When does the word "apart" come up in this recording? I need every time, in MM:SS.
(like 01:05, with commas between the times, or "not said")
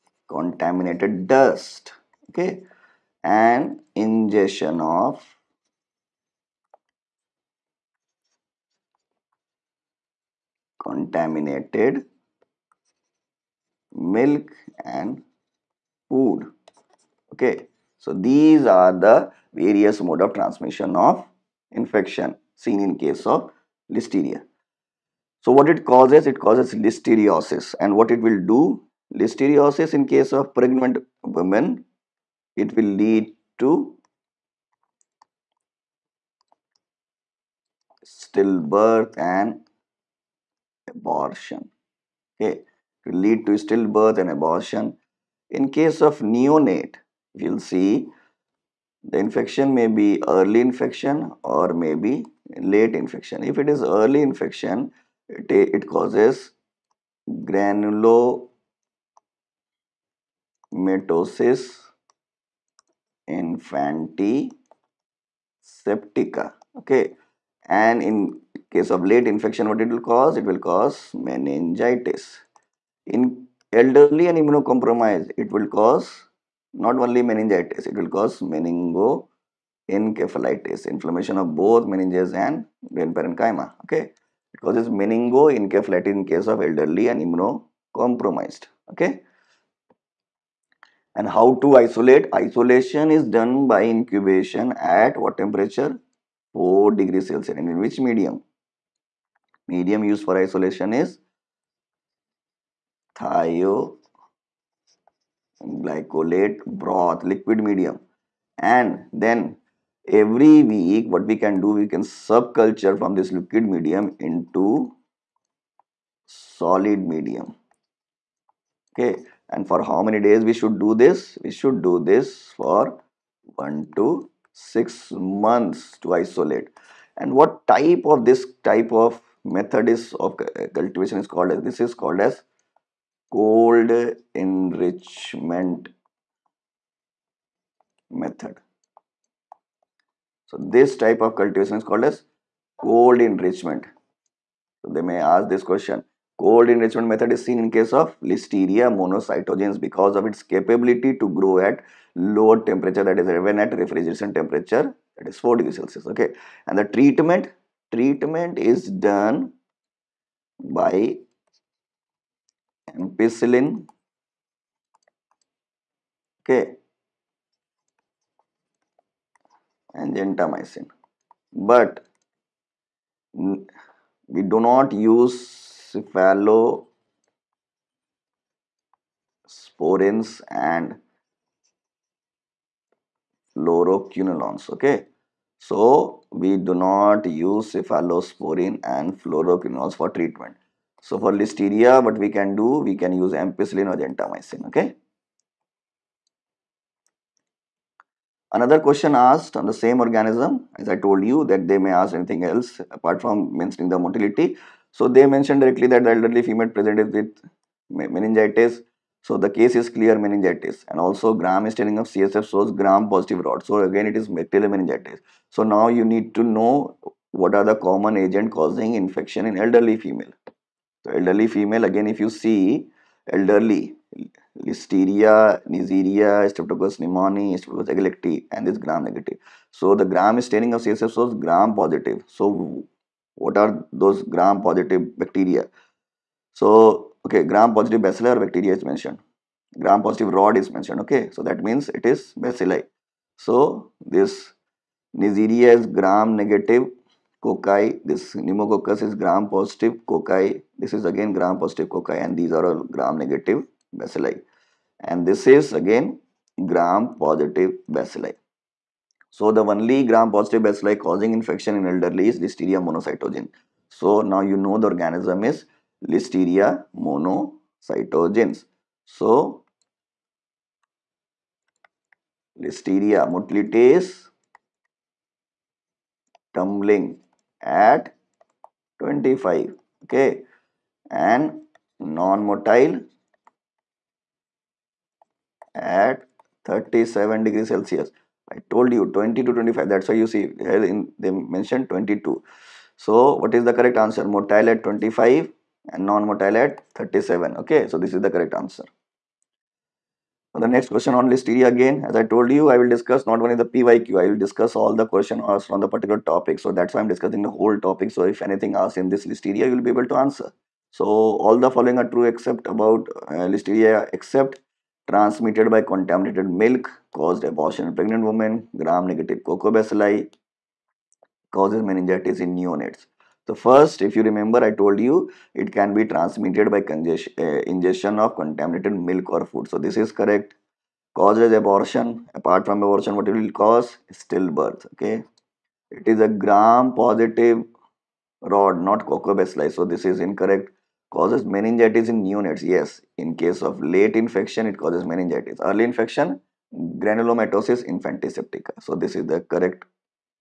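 03:22, 05:32.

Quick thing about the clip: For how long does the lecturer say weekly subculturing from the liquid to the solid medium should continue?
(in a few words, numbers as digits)
1 to 6 months.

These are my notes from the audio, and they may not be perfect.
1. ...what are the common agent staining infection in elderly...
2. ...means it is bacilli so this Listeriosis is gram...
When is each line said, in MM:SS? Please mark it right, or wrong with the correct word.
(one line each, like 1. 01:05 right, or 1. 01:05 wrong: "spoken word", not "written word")
1. 03:37 wrong: "causing", not "staining"
2. 04:01 wrong: "Neisseria", not "Listeriosis".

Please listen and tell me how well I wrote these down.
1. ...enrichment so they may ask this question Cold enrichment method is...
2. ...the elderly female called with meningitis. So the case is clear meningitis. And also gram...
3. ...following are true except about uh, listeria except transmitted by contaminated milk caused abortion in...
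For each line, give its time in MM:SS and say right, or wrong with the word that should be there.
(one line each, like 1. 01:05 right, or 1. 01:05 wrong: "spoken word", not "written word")
1. 02:23 right
2. 03:26 wrong: "presented", not "called"
3. 05:11 right.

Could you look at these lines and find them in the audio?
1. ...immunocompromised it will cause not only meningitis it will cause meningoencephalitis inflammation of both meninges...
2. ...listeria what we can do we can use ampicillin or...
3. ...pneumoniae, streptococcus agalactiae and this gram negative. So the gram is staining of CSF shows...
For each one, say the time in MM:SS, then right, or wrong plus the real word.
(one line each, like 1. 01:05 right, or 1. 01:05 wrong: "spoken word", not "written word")
1. 01:14 right
2. 03:11 right
3. 03:46 right.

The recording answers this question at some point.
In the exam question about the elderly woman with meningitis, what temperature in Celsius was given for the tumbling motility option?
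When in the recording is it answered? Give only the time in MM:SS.
04:51.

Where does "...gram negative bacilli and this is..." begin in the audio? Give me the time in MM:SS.
04:12.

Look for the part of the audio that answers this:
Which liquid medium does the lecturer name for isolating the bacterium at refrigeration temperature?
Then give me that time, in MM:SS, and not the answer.
01:43.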